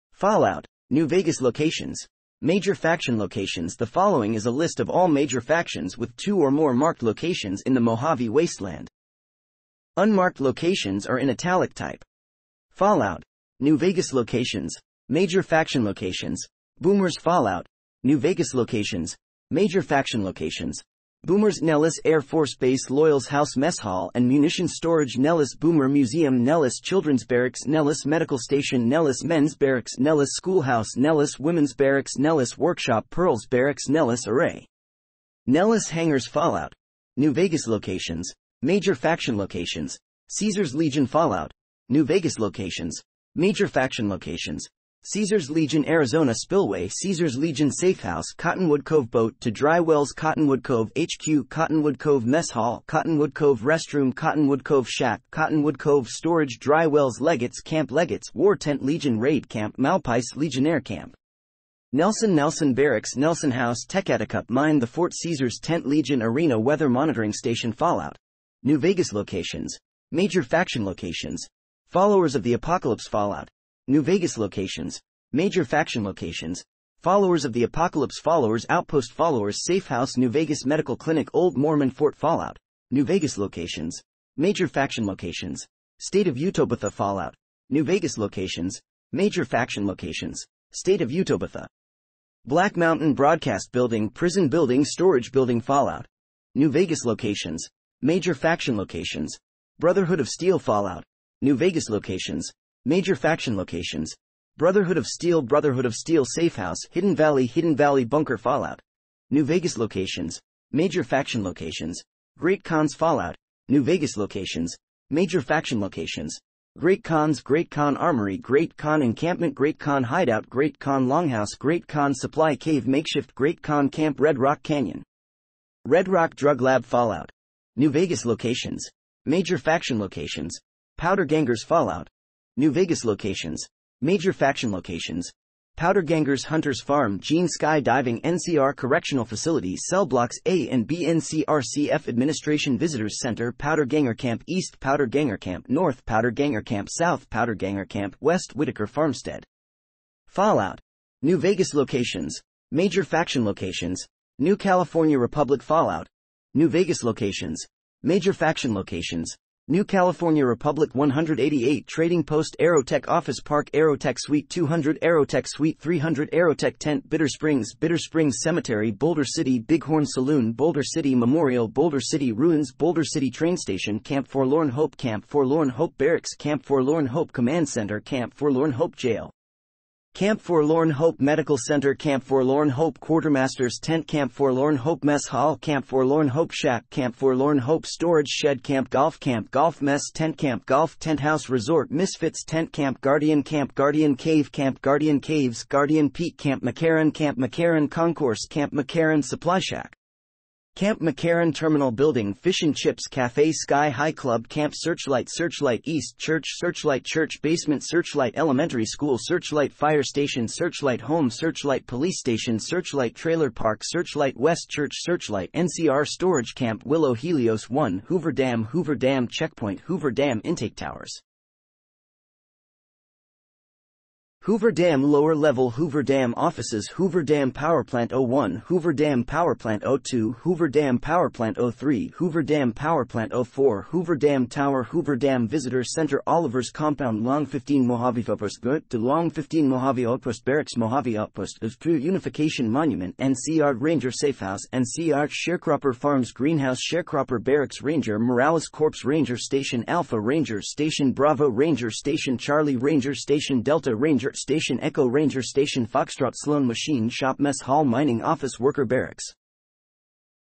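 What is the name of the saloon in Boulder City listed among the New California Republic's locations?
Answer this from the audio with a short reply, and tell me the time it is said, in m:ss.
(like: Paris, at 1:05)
Bighorn Saloon, at 2:48.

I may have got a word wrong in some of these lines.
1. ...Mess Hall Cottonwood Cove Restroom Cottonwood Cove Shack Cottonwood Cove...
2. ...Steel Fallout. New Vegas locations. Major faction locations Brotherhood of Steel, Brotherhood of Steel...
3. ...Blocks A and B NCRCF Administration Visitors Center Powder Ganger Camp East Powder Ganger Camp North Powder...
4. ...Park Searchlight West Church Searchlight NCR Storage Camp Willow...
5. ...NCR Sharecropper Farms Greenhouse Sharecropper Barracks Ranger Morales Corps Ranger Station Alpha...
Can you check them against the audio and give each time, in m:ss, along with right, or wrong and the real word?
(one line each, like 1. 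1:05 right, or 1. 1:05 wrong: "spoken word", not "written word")
1. 0:52 right
2. 1:40 right
3. 2:20 right
4. 3:33 right
5. 4:04 right.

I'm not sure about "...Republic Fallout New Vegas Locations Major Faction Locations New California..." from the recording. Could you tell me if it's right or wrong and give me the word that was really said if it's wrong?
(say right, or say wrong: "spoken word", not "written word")
right.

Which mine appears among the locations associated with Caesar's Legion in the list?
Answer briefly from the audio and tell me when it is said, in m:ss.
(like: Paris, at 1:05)
Techatticup Mine, at 1:03.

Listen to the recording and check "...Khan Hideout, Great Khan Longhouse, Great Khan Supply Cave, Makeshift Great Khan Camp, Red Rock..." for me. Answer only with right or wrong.
right.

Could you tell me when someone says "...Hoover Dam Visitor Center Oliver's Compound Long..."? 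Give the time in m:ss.
3:54.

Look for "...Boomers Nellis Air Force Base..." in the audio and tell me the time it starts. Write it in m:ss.
0:21.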